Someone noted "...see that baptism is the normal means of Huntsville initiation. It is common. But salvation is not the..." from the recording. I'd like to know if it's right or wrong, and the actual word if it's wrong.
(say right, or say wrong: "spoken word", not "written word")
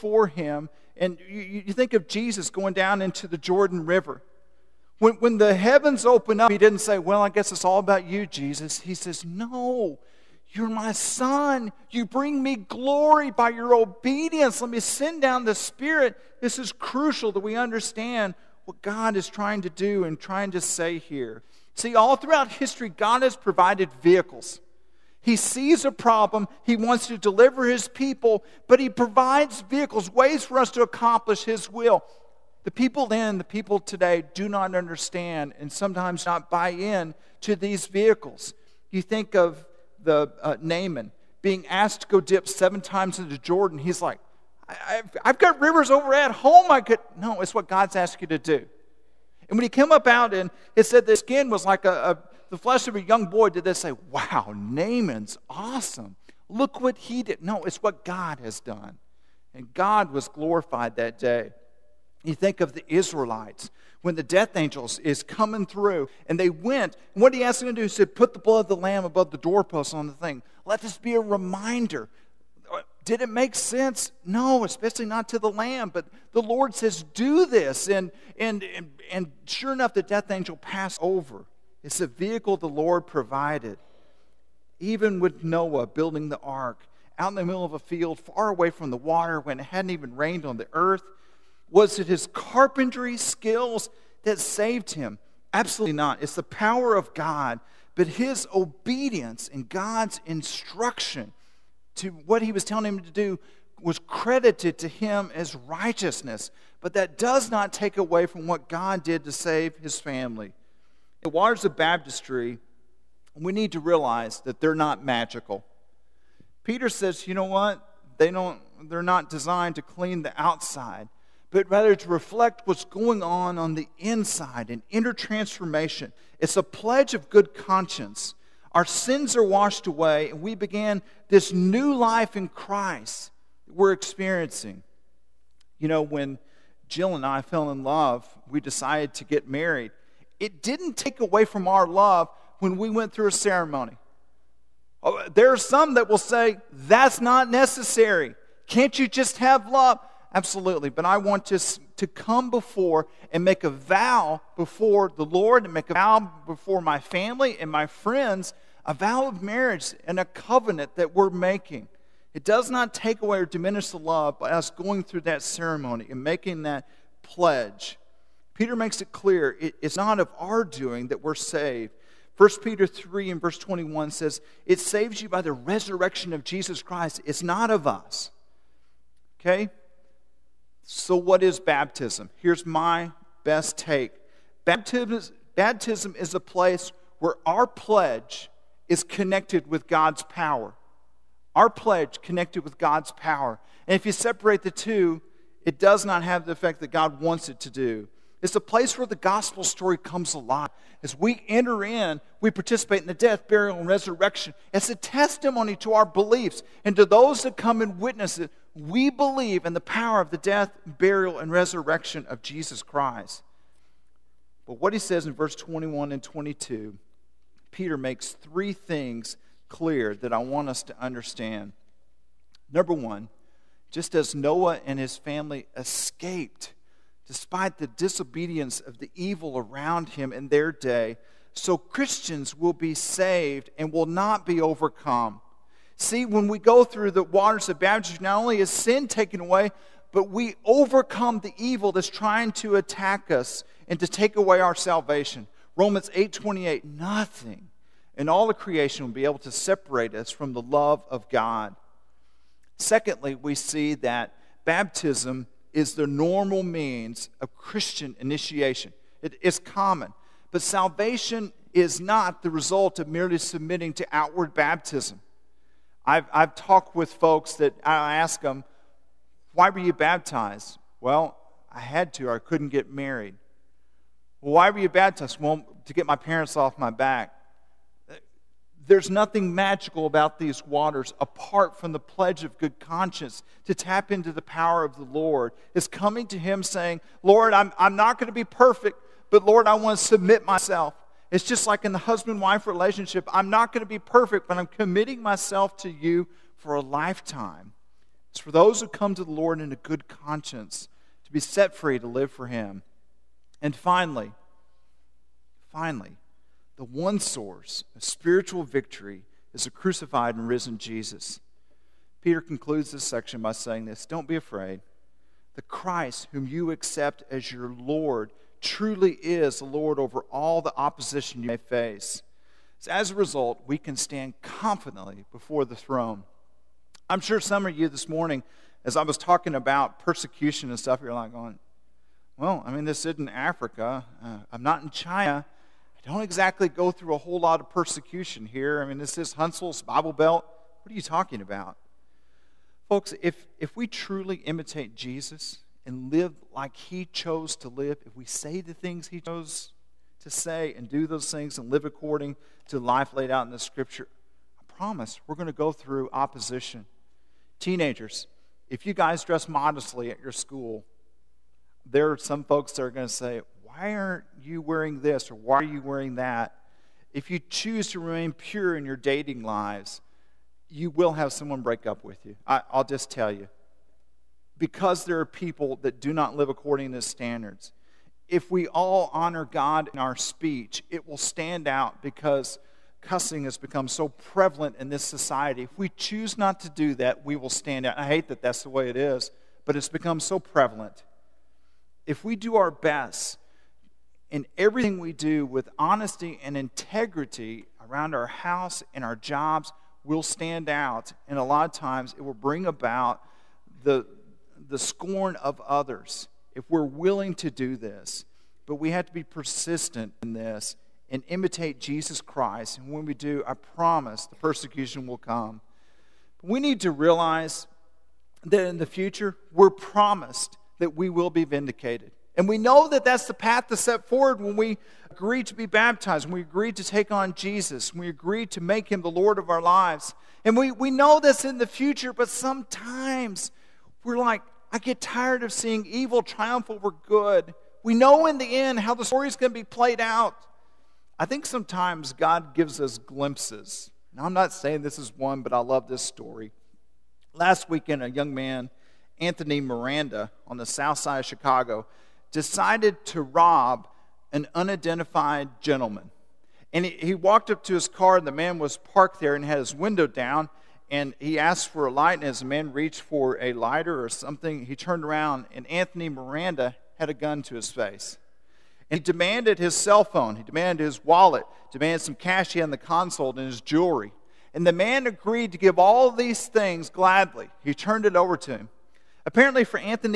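wrong: "Christian", not "Huntsville".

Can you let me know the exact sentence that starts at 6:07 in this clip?
If you choose to remain pure in your dating lives, you will have someone break up with you.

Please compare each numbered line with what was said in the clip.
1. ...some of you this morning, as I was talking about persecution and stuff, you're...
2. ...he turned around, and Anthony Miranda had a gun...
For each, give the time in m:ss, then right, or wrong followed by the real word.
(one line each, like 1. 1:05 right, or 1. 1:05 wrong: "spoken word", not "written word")
1. 5:27 right
2. 7:44 right.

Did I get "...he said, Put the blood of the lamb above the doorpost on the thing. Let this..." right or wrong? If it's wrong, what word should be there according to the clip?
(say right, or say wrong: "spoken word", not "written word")
right.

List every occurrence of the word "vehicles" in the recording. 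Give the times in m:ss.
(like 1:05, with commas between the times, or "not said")
0:24, 0:29, 0:37, 1:22.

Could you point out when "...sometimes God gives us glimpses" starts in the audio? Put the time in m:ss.
7:21.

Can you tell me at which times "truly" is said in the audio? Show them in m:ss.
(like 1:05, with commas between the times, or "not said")
5:18, 5:43.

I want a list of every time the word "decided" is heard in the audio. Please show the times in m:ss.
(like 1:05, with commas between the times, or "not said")
2:18, 7:32.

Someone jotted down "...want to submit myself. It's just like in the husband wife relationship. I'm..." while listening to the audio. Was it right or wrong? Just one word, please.
right.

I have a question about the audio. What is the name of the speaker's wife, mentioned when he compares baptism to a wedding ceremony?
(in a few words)
Jill.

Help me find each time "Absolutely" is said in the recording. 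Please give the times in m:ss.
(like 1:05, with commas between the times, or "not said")
1:35, 2:30.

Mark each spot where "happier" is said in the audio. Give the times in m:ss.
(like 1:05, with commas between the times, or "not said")
not said.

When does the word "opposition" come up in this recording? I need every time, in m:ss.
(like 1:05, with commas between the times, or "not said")
5:20, 5:56.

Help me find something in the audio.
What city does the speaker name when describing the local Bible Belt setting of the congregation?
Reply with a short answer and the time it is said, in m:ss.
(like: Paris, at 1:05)
Huntsville, at 5:39.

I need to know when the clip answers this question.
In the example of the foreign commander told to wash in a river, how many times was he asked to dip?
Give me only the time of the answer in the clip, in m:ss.
0:42.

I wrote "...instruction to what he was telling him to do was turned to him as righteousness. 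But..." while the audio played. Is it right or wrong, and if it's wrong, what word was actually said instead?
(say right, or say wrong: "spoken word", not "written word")
wrong: "credited", not "turned".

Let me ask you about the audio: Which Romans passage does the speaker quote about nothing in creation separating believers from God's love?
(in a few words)
Romans 8:28.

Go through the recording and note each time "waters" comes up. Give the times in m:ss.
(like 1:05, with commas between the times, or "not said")
1:28, 1:51, 3:57, 4:40.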